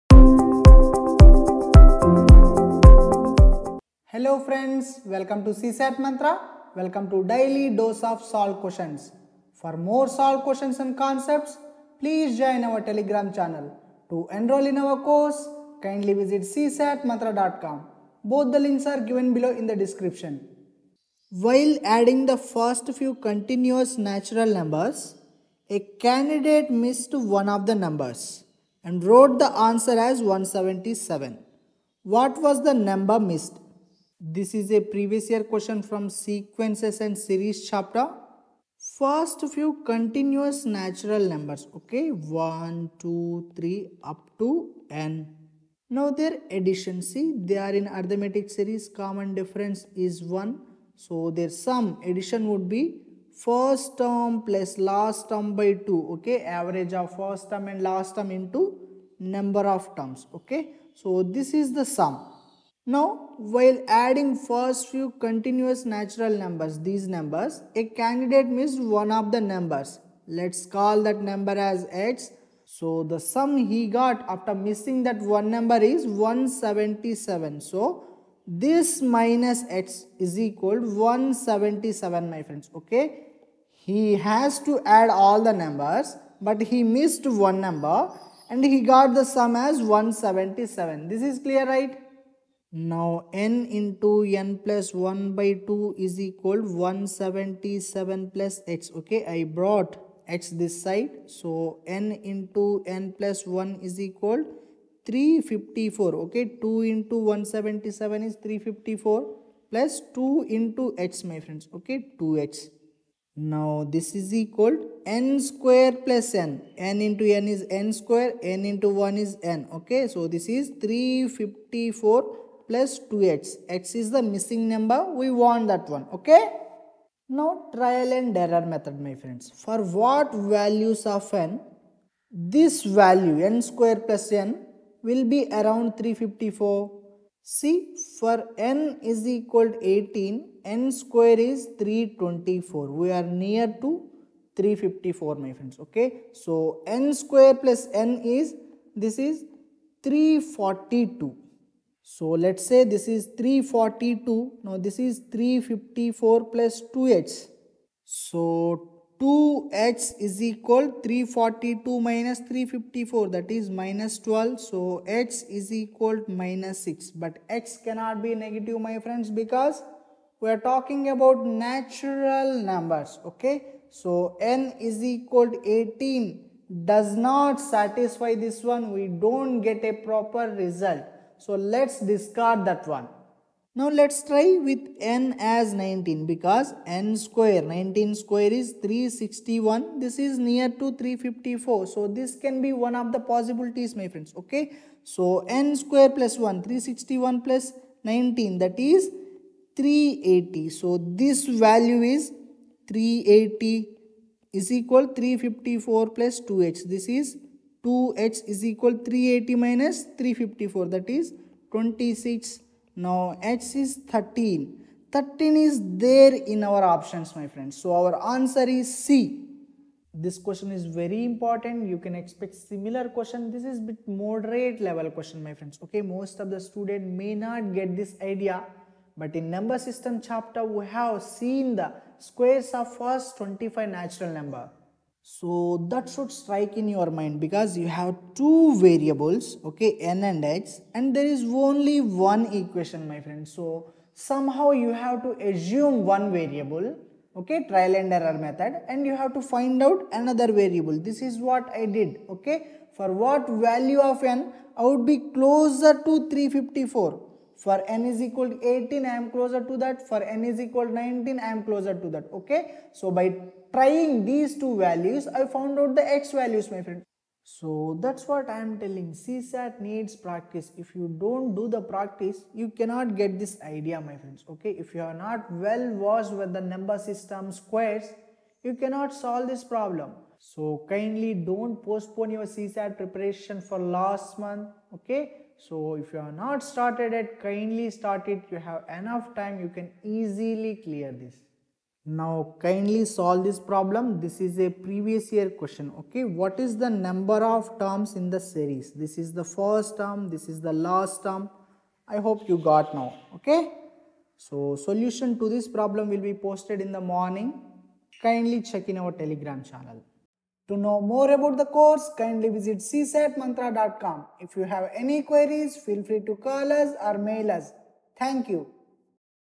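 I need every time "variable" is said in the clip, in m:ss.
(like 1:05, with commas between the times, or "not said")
3:58, 4:06, 4:10.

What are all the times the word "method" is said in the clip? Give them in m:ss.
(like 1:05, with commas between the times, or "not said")
2:08, 4:08.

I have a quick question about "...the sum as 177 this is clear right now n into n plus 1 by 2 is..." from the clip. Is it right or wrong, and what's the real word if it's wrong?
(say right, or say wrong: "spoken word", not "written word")
right.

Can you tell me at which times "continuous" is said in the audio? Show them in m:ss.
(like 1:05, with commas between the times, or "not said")
0:23, 0:39, 1:05.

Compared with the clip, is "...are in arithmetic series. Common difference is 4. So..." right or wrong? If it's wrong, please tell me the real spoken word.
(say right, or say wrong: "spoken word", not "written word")
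wrong: "1", not "4".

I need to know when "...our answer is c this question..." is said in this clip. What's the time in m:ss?
3:38.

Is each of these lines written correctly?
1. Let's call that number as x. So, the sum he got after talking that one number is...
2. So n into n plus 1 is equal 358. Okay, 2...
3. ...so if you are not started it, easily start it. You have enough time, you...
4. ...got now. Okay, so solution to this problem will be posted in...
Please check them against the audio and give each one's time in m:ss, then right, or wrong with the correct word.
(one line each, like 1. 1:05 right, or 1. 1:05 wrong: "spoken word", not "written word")
1. 1:10 wrong: "missing", not "talking"
2. 1:41 wrong: "354", not "358"
3. 4:45 wrong: "kindly", not "easily"
4. 5:02 right.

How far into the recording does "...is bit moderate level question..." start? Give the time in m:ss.
3:43.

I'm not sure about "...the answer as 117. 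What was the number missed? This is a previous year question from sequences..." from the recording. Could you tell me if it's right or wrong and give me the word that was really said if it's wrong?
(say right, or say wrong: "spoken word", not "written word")
wrong: "177", not "117".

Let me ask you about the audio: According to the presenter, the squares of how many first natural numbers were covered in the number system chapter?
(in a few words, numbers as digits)
25.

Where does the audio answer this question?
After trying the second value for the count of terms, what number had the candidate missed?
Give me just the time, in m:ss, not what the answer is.
3:33.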